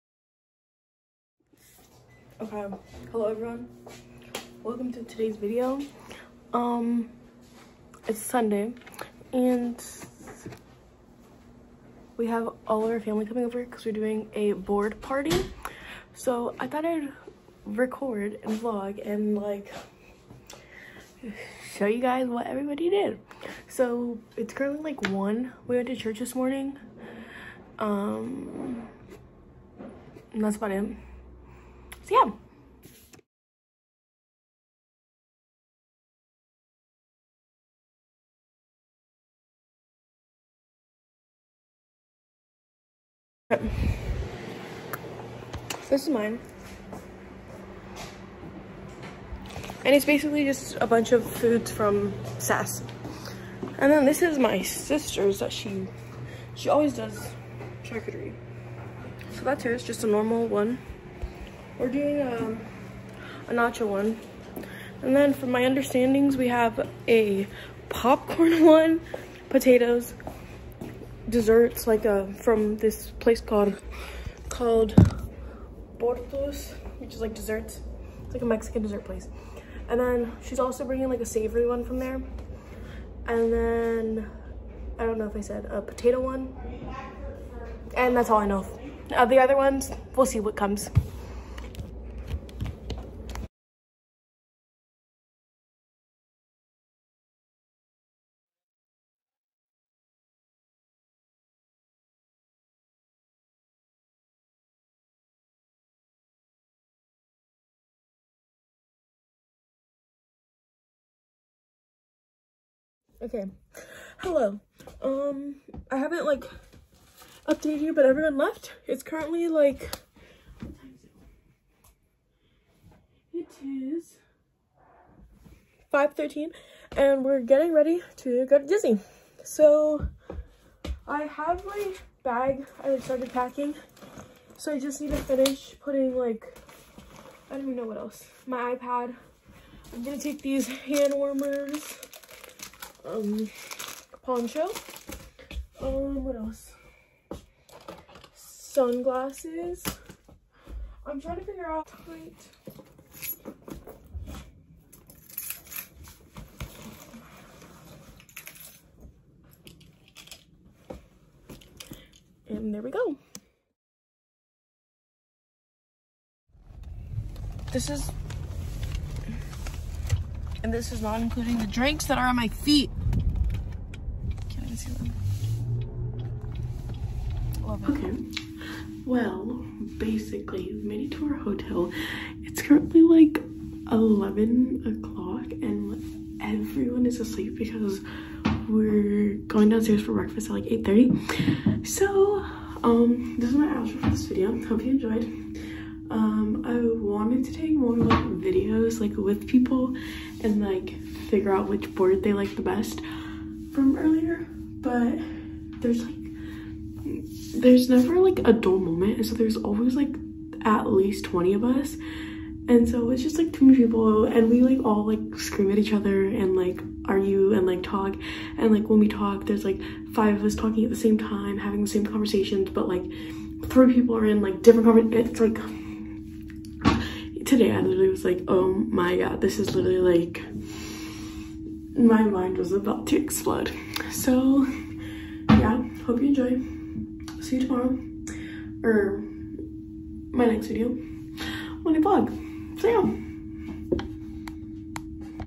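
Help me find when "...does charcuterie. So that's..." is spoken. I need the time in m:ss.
0:56.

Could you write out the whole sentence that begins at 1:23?
And then, I don't know if I said a potato one.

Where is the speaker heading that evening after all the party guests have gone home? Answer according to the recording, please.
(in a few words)
Disney.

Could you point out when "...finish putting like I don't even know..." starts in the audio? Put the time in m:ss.
2:15.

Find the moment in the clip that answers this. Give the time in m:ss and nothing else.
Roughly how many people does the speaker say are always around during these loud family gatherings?
3:31.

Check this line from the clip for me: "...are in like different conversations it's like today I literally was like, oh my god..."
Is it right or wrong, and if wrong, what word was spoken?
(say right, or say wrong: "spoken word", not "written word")
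right.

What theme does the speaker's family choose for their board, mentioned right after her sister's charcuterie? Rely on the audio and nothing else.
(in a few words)
Nacho.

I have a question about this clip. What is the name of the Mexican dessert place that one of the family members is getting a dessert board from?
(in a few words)
Bortos.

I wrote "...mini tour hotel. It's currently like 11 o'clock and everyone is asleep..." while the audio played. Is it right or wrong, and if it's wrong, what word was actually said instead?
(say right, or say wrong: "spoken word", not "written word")
right.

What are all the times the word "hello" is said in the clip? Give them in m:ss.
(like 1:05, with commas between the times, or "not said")
0:03, 1:54.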